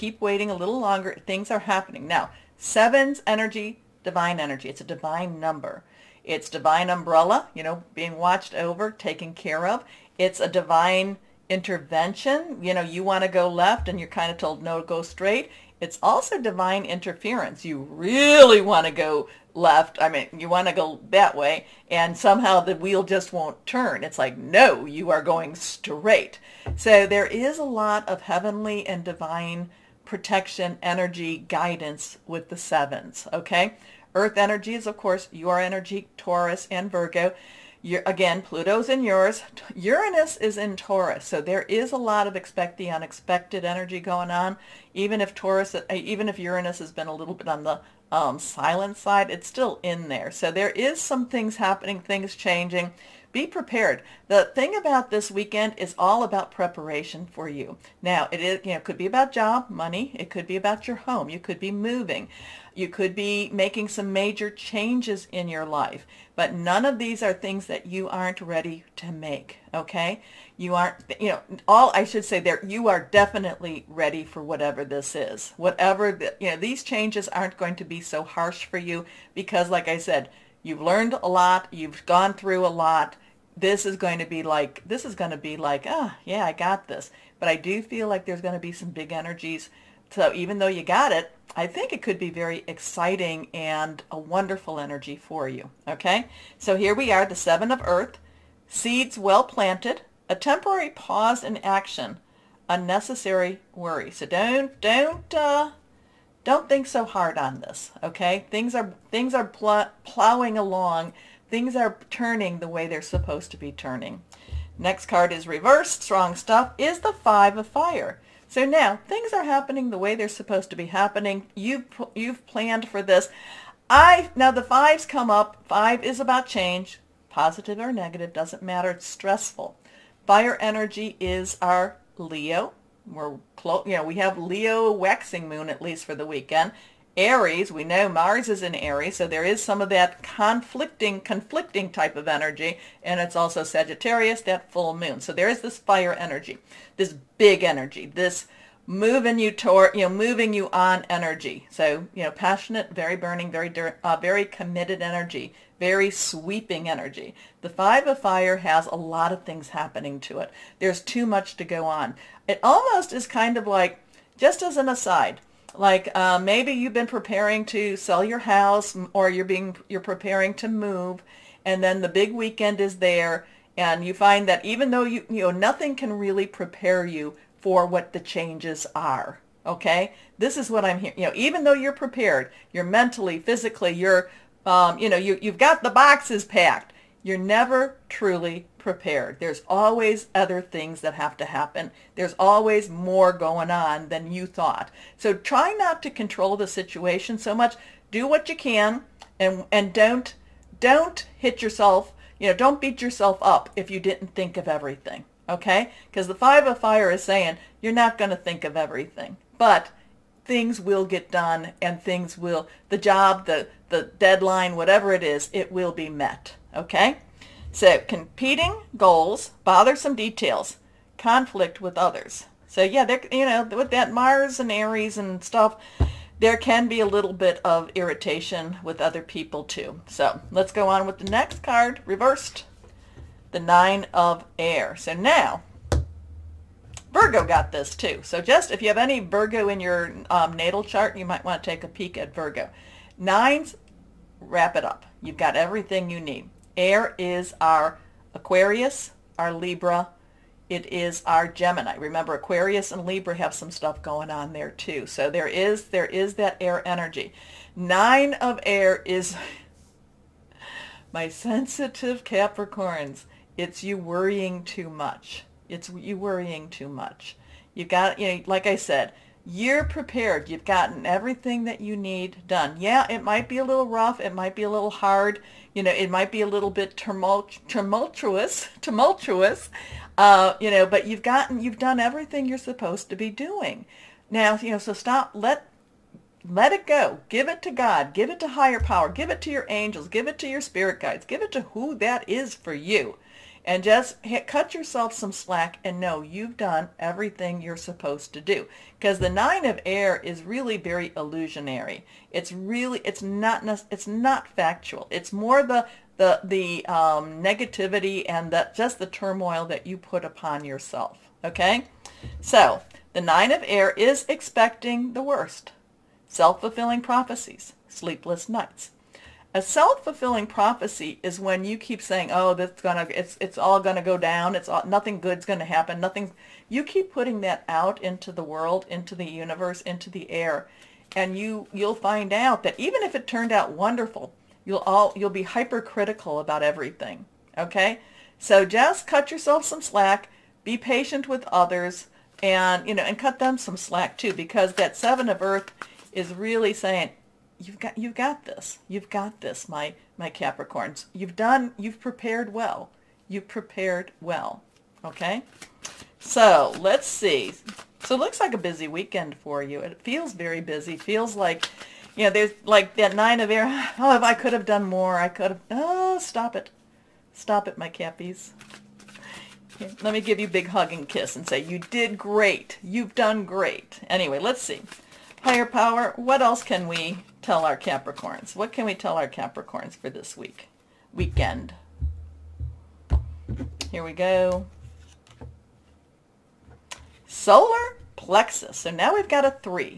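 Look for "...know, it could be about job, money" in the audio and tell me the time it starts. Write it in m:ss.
0:58.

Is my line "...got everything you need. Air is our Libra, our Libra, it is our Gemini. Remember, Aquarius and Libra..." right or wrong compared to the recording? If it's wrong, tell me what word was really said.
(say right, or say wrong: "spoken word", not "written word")
wrong: "Aquarius", not "Libra".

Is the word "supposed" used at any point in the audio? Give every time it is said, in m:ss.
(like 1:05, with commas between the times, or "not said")
1:53, 2:00, 4:42, 4:57.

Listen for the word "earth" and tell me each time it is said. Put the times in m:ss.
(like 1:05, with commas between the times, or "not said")
0:34, 1:37, 5:45.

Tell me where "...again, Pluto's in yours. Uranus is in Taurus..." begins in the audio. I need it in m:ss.
0:38.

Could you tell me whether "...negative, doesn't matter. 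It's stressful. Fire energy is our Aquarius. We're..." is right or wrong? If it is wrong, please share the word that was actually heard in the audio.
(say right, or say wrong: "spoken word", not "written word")
wrong: "Leo", not "Aquarius".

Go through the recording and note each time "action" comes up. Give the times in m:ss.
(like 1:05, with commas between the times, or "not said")
1:41.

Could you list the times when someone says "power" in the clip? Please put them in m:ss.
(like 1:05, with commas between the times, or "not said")
4:48, 6:15.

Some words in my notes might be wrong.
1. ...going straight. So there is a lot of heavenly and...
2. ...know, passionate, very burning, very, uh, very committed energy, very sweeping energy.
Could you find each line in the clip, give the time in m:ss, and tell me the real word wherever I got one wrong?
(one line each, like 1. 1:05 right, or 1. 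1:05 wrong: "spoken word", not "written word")
1. 0:25 right
2. 2:32 right.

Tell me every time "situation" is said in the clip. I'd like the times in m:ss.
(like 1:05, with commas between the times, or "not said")
3:16.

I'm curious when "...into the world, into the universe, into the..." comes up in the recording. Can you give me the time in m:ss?
5:28.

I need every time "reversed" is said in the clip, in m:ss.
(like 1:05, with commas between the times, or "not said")
1:55, 3:52.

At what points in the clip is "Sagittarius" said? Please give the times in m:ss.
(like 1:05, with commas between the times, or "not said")
2:23.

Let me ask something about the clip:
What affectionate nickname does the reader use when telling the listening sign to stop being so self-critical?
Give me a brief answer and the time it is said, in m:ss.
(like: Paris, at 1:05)
cappies, at 6:07.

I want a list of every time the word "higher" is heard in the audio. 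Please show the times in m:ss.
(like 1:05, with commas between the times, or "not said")
4:48, 6:15.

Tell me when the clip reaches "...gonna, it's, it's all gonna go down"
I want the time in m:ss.
5:22.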